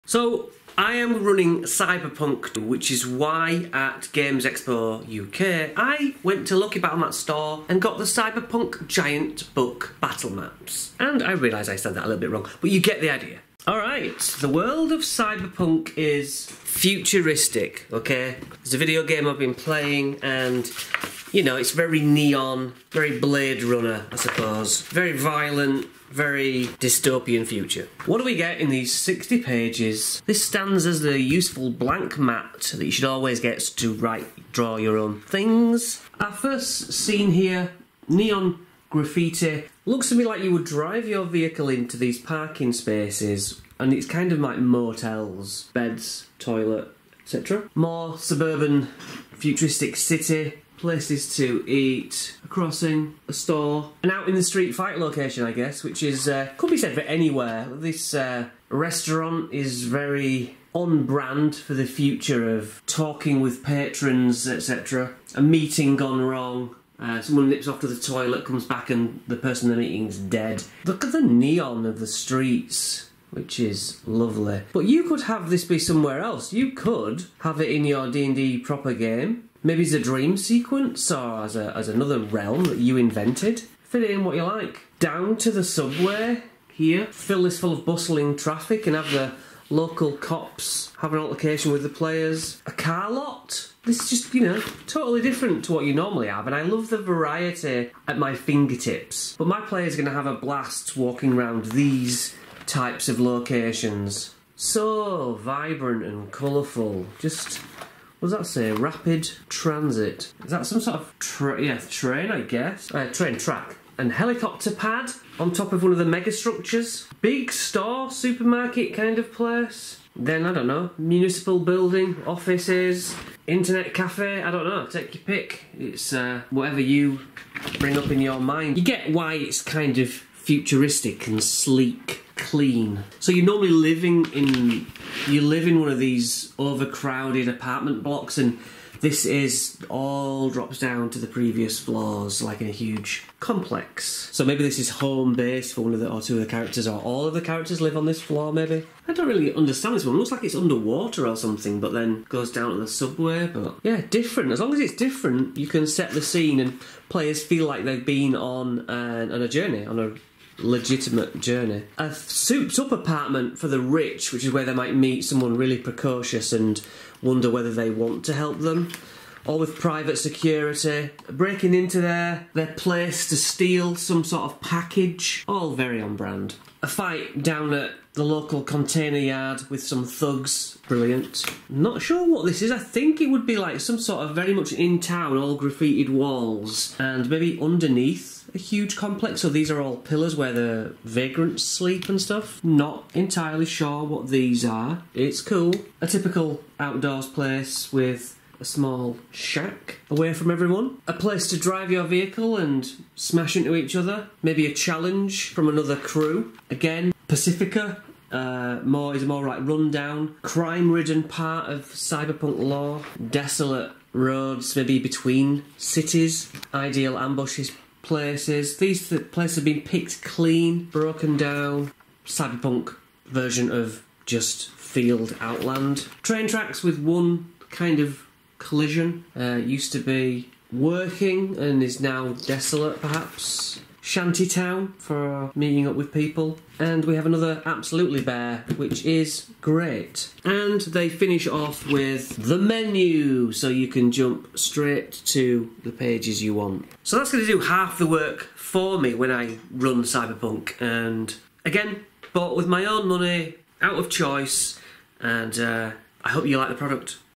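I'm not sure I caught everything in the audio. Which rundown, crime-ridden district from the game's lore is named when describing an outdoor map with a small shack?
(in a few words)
Pacifica.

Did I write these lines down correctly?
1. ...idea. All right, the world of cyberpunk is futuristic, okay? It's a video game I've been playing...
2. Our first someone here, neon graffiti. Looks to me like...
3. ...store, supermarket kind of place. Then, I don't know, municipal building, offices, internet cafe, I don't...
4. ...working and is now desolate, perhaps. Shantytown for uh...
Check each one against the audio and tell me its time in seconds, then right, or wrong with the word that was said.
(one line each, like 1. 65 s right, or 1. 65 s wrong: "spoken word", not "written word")
1. 13 s right
2. 36 s wrong: "scene", not "someone"
3. 117 s right
4. 230 s right.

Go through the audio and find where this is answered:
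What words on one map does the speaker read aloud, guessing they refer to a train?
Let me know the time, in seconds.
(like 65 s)
108 s.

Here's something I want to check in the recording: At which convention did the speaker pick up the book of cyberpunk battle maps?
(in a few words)
Games Expo UK.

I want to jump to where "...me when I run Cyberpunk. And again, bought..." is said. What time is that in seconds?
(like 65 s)
248 s.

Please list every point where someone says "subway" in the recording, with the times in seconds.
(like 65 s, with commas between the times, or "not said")
85 s, 152 s.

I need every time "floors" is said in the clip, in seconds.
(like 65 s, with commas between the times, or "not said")
141 s, 148 s.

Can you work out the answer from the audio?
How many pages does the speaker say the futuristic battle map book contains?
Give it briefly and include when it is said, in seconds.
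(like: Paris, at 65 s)
60, at 28 s.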